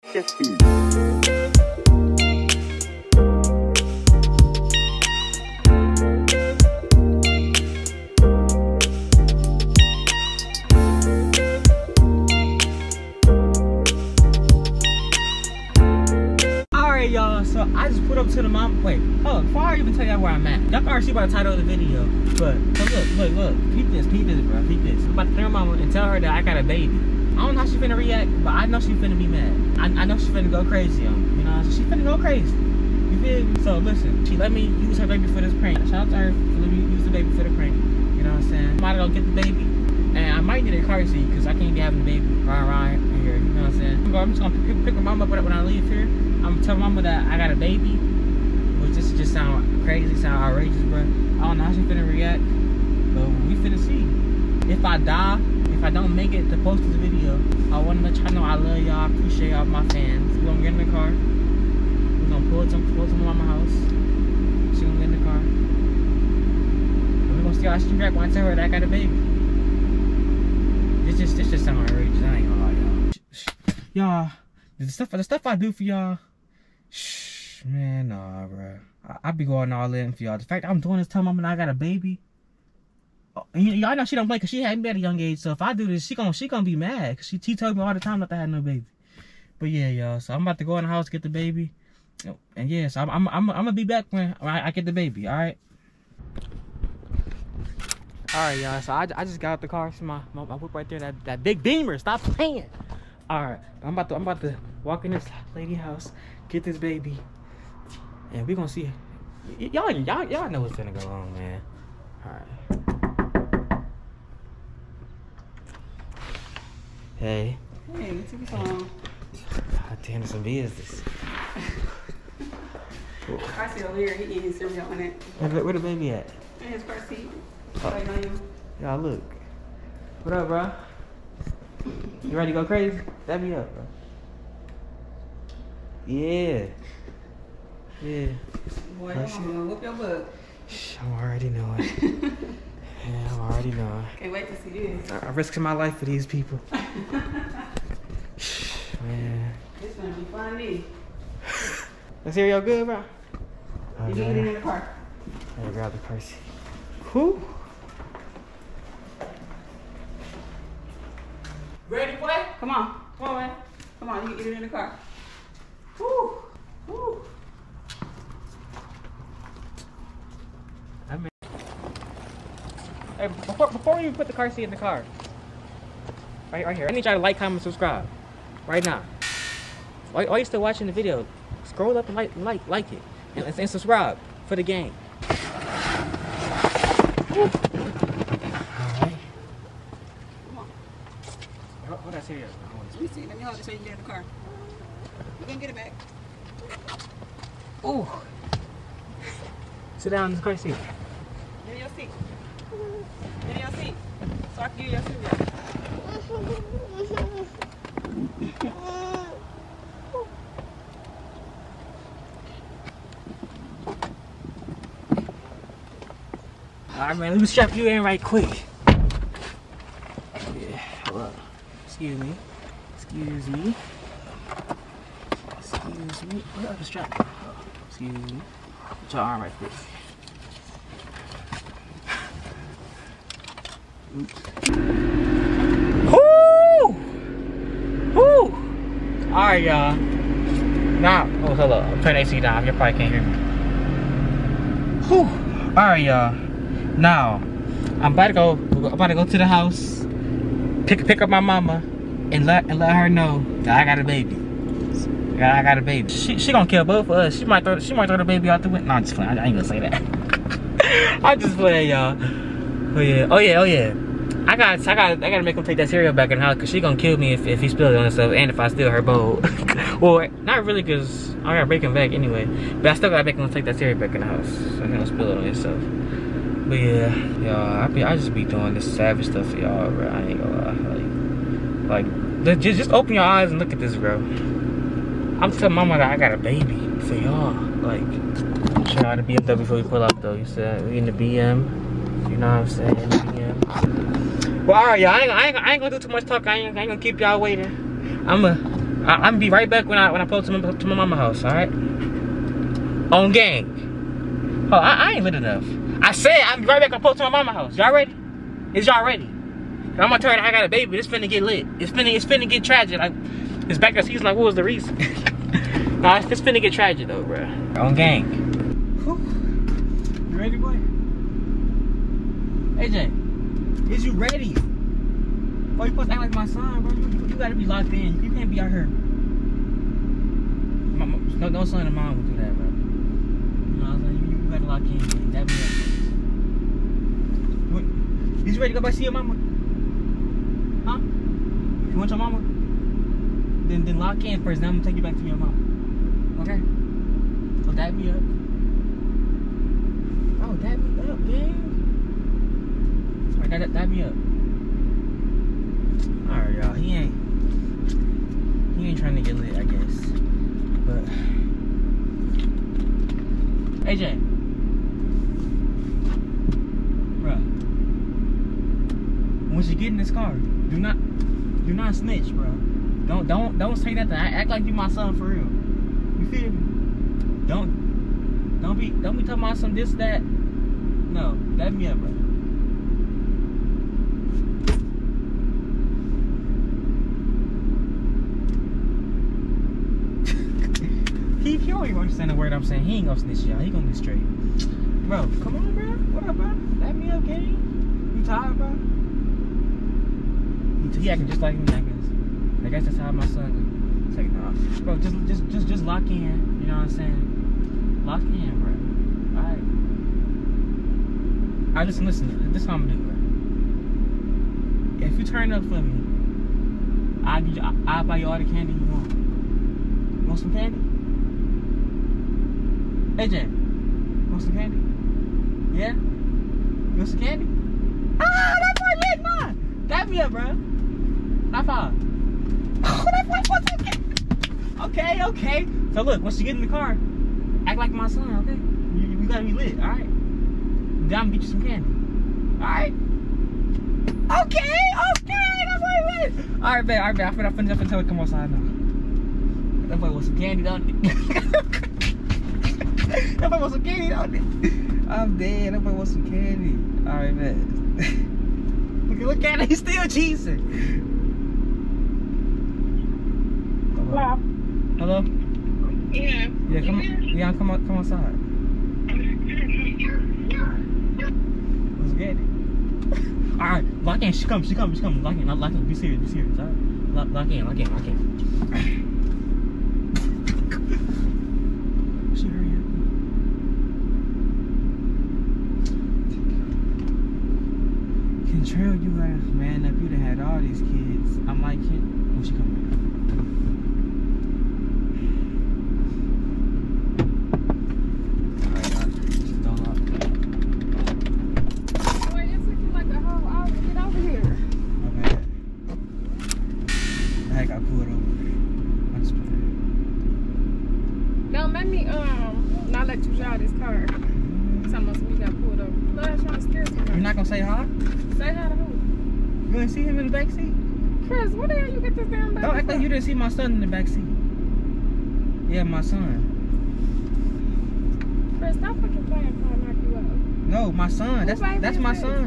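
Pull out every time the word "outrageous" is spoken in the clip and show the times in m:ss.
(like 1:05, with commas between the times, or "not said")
0:50, 1:11.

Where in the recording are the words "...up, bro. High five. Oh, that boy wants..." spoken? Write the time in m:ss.
7:10.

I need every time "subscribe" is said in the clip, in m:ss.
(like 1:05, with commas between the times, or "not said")
2:57, 3:03.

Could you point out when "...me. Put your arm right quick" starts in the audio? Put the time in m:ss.
3:48.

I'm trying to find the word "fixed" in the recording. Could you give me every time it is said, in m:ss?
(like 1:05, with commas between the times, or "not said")
not said.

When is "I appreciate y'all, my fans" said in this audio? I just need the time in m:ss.
0:58.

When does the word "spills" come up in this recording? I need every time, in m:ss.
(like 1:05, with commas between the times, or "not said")
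4:27, 4:35.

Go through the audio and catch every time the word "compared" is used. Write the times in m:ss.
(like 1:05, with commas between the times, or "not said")
not said.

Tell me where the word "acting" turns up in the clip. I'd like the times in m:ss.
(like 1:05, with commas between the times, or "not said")
6:41.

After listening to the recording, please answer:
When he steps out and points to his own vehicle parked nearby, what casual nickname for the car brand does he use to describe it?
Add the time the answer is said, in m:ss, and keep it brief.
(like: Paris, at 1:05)
Beamer, at 1:41.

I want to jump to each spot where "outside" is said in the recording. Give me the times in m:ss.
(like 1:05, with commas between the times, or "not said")
7:28, 7:47.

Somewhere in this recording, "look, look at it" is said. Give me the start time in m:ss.
7:39.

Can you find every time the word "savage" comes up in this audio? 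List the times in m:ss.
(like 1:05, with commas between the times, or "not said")
4:38.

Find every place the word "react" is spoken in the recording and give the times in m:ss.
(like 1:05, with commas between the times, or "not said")
0:27, 0:52, 1:07.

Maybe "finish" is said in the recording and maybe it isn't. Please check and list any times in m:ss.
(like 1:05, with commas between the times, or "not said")
7:27.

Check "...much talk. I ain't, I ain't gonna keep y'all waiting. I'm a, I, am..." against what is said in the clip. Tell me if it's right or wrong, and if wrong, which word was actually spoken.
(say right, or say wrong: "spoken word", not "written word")
right.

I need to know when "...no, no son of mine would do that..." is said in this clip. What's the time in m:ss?
5:31.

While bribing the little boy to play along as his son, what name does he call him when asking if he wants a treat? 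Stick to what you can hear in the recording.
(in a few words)
Jamie.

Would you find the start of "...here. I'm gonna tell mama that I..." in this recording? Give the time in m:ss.
0:45.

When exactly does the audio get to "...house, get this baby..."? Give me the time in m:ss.
1:45.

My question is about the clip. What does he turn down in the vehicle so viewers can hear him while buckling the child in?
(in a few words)
AC.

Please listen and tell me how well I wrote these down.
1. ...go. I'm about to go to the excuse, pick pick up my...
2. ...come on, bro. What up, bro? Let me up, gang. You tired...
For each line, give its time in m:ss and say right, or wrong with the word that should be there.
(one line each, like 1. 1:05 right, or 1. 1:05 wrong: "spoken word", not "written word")
1. 4:08 wrong: "house", not "excuse"
2. 6:35 right.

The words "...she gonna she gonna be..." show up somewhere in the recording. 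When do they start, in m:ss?
1:26.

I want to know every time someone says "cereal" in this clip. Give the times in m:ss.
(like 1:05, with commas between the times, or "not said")
2:04, 4:25, 4:33.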